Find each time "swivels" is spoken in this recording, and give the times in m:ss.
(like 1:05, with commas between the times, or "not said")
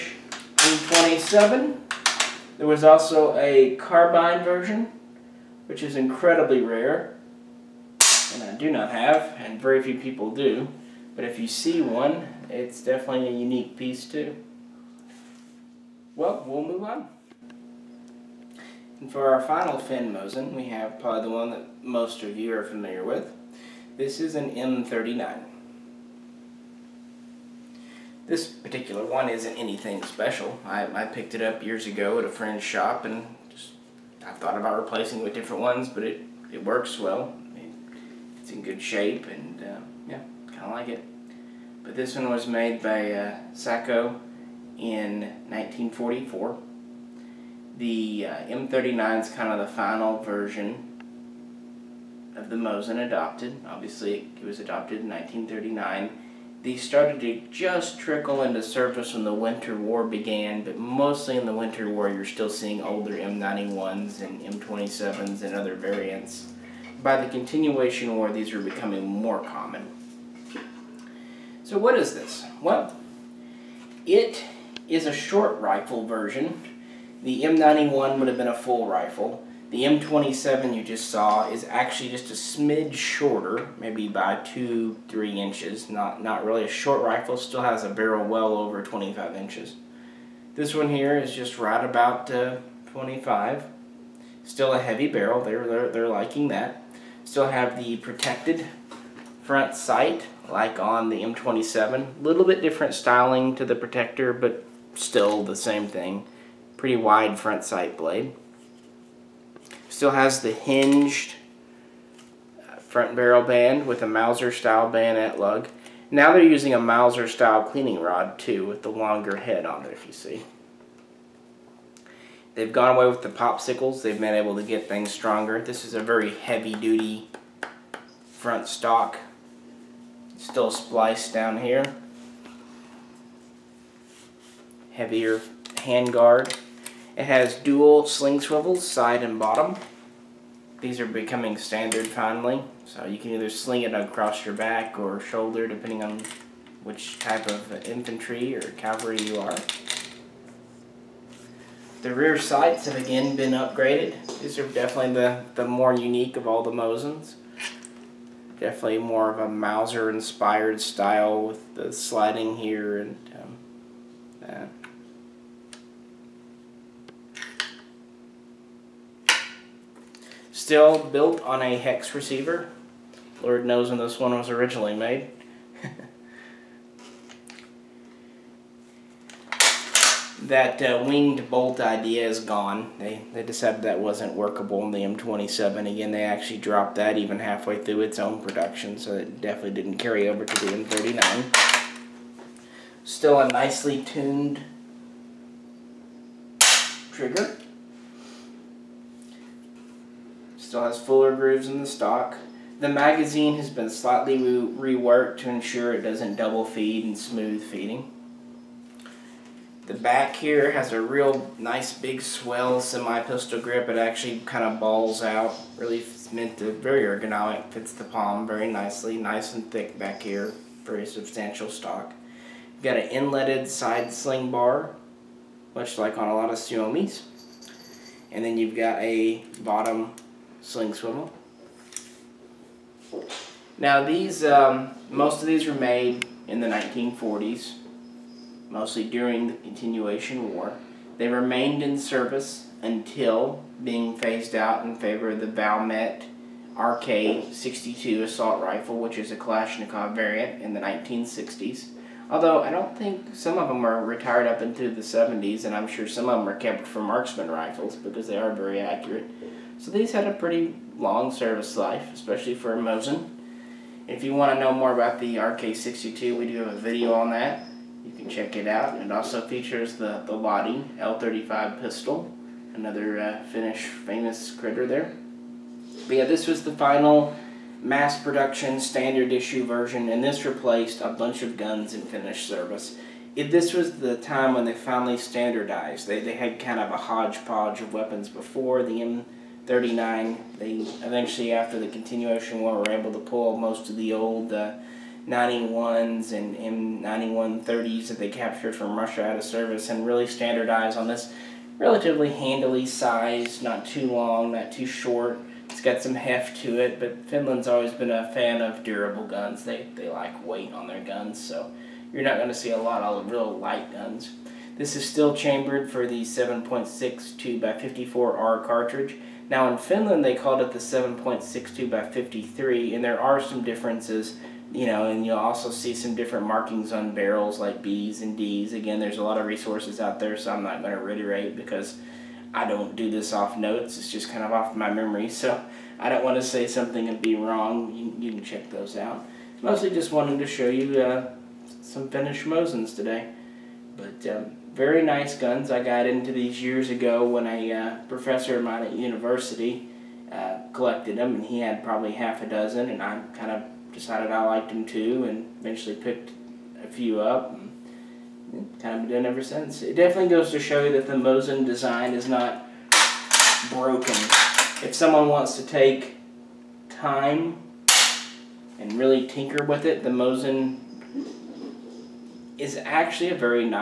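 2:18, 3:50.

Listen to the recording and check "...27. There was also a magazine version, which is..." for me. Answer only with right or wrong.
wrong.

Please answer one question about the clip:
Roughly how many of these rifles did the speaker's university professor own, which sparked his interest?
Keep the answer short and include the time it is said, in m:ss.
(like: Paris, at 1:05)
half a dozen, at 5:52.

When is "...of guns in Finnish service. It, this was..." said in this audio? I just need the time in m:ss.
4:41.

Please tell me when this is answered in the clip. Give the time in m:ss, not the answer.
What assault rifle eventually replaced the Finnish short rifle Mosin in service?
4:05.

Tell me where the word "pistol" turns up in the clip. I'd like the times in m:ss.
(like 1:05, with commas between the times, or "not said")
3:32, 4:31.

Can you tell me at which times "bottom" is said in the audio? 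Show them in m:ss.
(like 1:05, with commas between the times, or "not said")
2:19, 3:49.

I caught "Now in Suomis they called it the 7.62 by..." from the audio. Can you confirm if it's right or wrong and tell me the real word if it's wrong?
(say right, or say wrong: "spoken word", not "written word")
wrong: "Finland", not "Suomis".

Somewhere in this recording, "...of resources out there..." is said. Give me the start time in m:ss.
5:29.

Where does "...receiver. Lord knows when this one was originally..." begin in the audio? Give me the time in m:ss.
2:52.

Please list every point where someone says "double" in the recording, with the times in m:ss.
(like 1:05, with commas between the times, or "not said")
3:26.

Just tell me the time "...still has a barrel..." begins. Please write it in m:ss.
1:27.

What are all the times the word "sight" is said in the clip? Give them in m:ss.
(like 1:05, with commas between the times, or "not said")
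1:39, 1:47, 2:32.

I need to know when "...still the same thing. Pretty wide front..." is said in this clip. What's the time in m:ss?
1:44.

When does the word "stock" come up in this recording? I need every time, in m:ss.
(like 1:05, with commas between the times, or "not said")
2:08, 3:21, 3:41.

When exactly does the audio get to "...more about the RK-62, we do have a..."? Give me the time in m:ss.
4:24.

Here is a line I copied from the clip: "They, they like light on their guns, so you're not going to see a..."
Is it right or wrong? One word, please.
wrong.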